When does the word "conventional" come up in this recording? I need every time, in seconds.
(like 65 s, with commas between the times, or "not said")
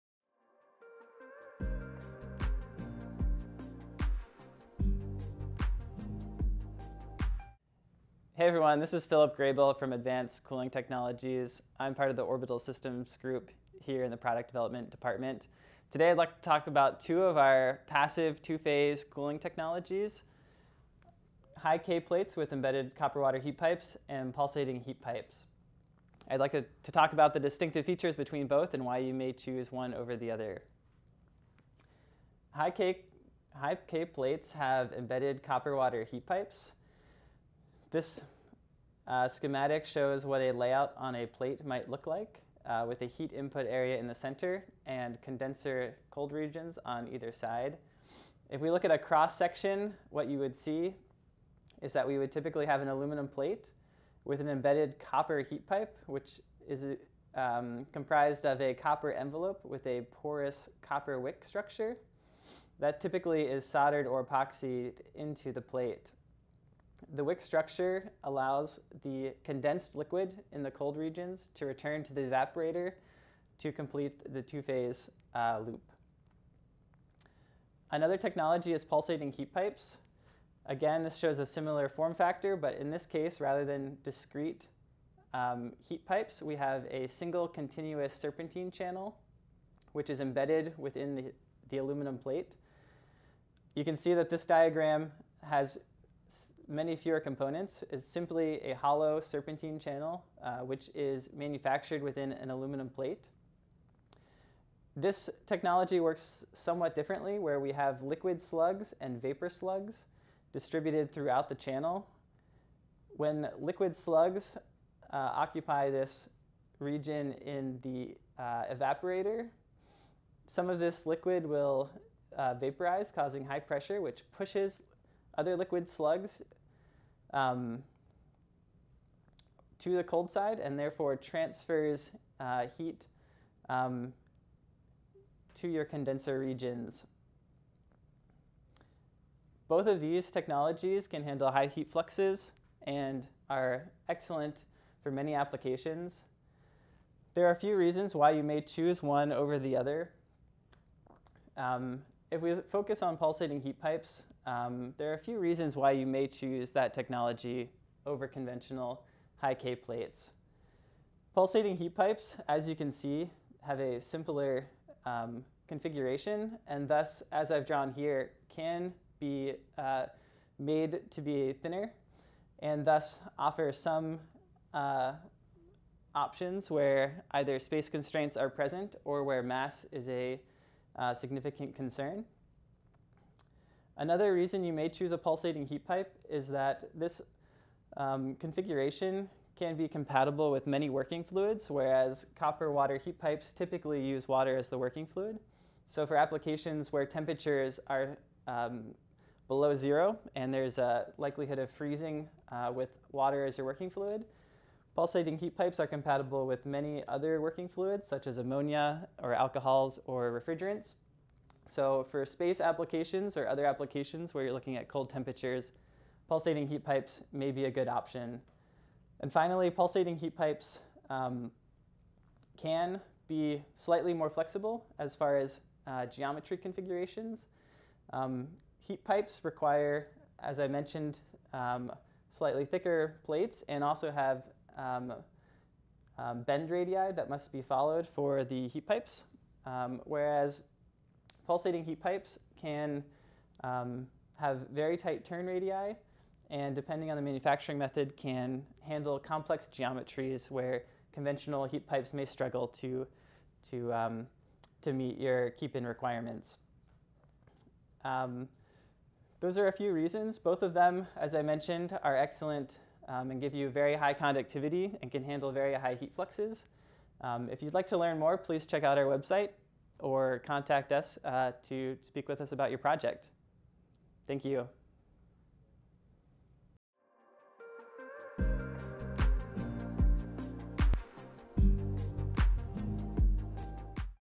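158 s, 251 s.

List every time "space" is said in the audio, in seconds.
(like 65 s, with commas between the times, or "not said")
177 s, 212 s.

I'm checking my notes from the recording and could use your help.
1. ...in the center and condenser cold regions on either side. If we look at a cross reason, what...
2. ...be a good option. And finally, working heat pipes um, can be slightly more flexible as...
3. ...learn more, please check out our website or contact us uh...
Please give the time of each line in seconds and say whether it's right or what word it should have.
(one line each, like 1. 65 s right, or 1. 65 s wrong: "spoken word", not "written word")
1. 43 s wrong: "section", not "reason"
2. 217 s wrong: "pulsating", not "working"
3. 267 s right.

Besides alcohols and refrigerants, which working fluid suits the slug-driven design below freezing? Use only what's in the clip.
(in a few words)
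ammonia.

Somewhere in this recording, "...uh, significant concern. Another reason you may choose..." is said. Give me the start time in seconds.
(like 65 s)
180 s.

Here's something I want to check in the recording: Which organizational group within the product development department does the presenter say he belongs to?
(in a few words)
Orbital Systems.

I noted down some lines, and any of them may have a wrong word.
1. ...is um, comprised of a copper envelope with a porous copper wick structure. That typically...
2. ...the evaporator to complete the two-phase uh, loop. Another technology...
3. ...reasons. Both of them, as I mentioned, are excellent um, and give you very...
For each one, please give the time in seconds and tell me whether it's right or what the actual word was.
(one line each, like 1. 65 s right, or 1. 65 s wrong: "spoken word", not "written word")
1. 56 s right
2. 72 s right
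3. 259 s right.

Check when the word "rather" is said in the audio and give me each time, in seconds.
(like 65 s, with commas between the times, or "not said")
83 s.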